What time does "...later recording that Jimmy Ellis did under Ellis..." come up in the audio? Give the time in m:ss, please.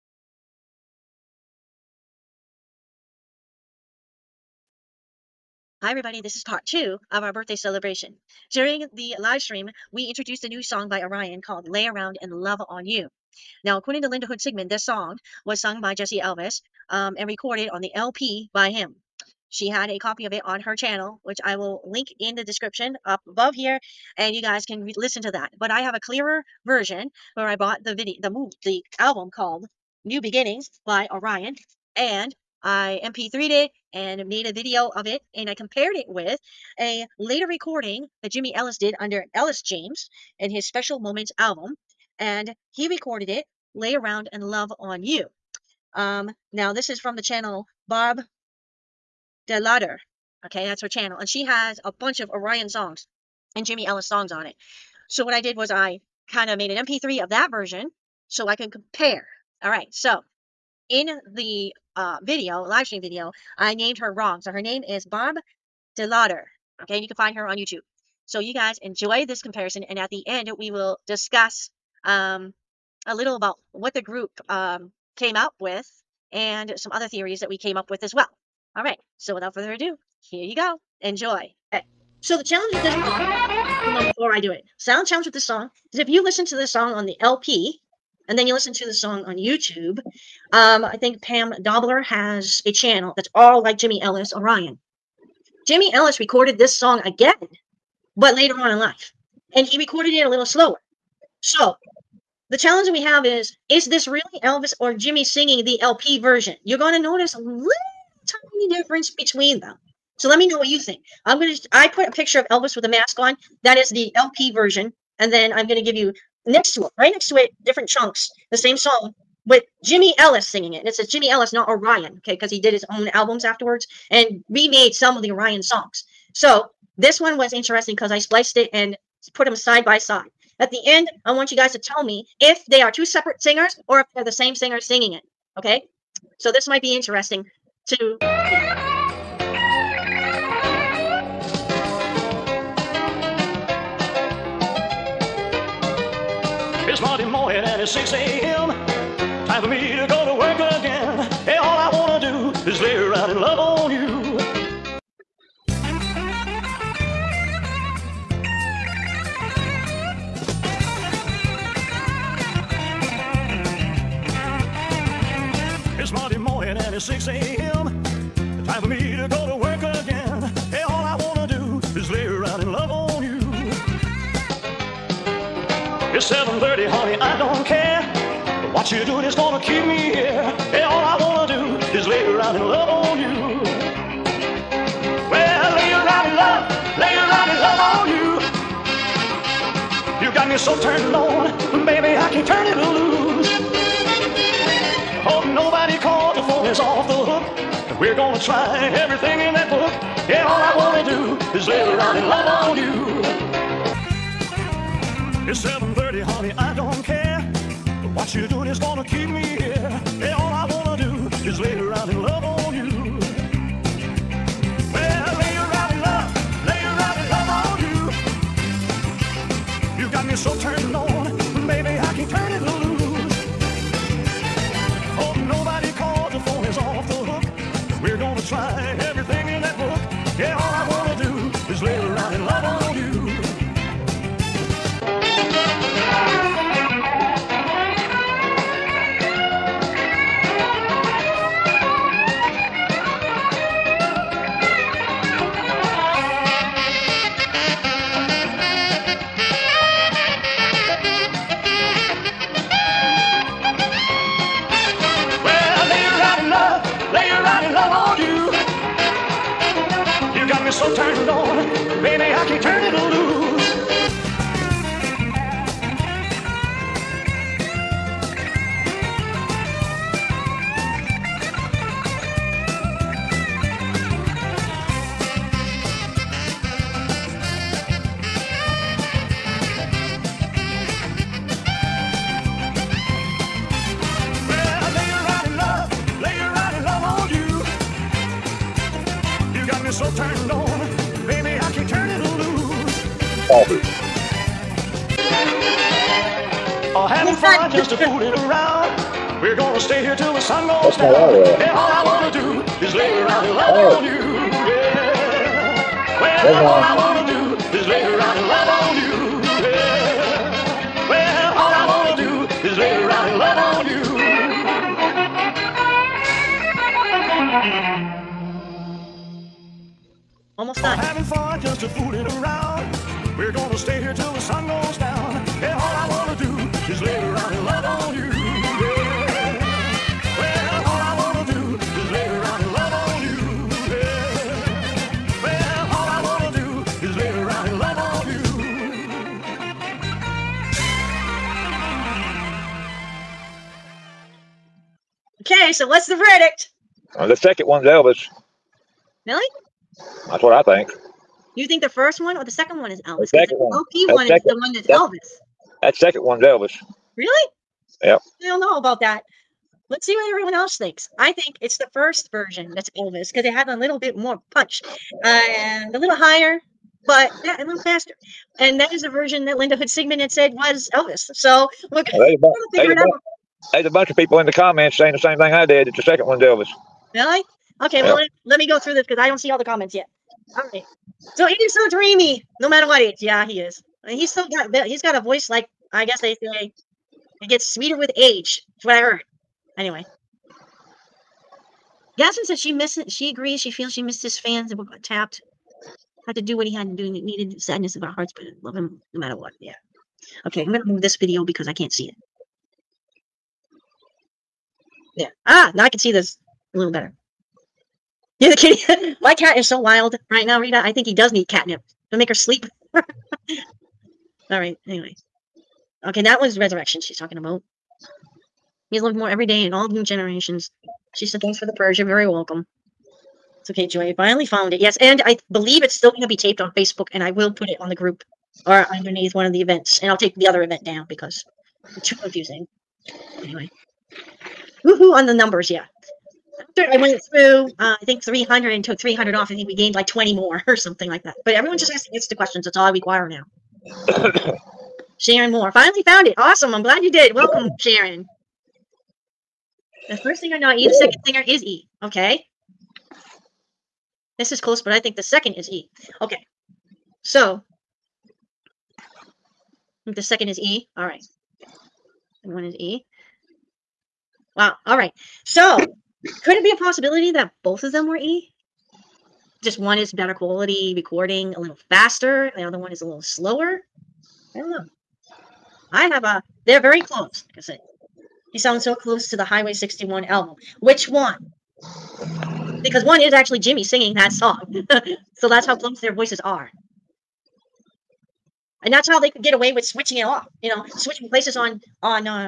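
0:37.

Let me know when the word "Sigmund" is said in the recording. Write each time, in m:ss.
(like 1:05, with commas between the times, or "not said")
0:14, 6:09.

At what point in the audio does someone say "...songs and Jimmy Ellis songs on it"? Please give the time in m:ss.
0:52.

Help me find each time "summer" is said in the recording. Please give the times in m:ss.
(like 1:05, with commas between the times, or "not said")
not said.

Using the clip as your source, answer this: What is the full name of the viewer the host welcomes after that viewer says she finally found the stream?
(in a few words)
Sharon Moore.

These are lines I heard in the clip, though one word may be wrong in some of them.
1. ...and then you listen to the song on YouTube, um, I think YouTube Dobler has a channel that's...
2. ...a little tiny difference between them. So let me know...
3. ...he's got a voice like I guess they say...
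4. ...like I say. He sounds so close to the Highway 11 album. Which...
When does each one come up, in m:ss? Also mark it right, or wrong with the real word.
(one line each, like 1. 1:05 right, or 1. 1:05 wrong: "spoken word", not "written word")
1. 1:28 wrong: "Pam", not "YouTube"
2. 1:47 right
3. 6:24 right
4. 7:57 wrong: "61", not "11".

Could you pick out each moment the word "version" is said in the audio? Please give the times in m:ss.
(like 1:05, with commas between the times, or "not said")
0:26, 0:57, 1:46, 1:54, 6:02, 6:09.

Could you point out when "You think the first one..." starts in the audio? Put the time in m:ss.
5:51.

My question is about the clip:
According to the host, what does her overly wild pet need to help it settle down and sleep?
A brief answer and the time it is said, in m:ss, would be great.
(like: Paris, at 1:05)
catnip, at 6:51.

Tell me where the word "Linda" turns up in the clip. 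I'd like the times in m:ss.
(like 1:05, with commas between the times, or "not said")
0:14, 6:09.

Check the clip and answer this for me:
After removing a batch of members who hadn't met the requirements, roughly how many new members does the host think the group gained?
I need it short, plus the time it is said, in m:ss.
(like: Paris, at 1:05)
20, at 7:20.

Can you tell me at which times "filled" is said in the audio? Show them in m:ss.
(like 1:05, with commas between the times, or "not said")
not said.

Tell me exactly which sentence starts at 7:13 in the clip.
Anyway, woohoo on the numbers, yeah.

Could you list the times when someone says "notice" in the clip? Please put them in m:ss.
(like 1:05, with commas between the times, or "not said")
1:47.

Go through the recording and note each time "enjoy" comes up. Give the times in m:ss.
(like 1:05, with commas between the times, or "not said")
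1:08, 1:21.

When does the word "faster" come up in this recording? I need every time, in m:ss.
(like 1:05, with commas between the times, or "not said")
6:07, 7:51.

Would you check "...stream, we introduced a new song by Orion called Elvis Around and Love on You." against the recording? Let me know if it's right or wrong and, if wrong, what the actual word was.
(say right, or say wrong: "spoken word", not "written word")
wrong: "Lay", not "Elvis".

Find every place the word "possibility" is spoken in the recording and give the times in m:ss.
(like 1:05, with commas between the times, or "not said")
7:46.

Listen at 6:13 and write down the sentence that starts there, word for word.
There's a bunch of people in the comments saying the same thing I did that the second one's Elvis.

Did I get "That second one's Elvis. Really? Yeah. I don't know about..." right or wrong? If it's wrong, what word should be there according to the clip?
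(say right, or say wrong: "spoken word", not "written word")
right.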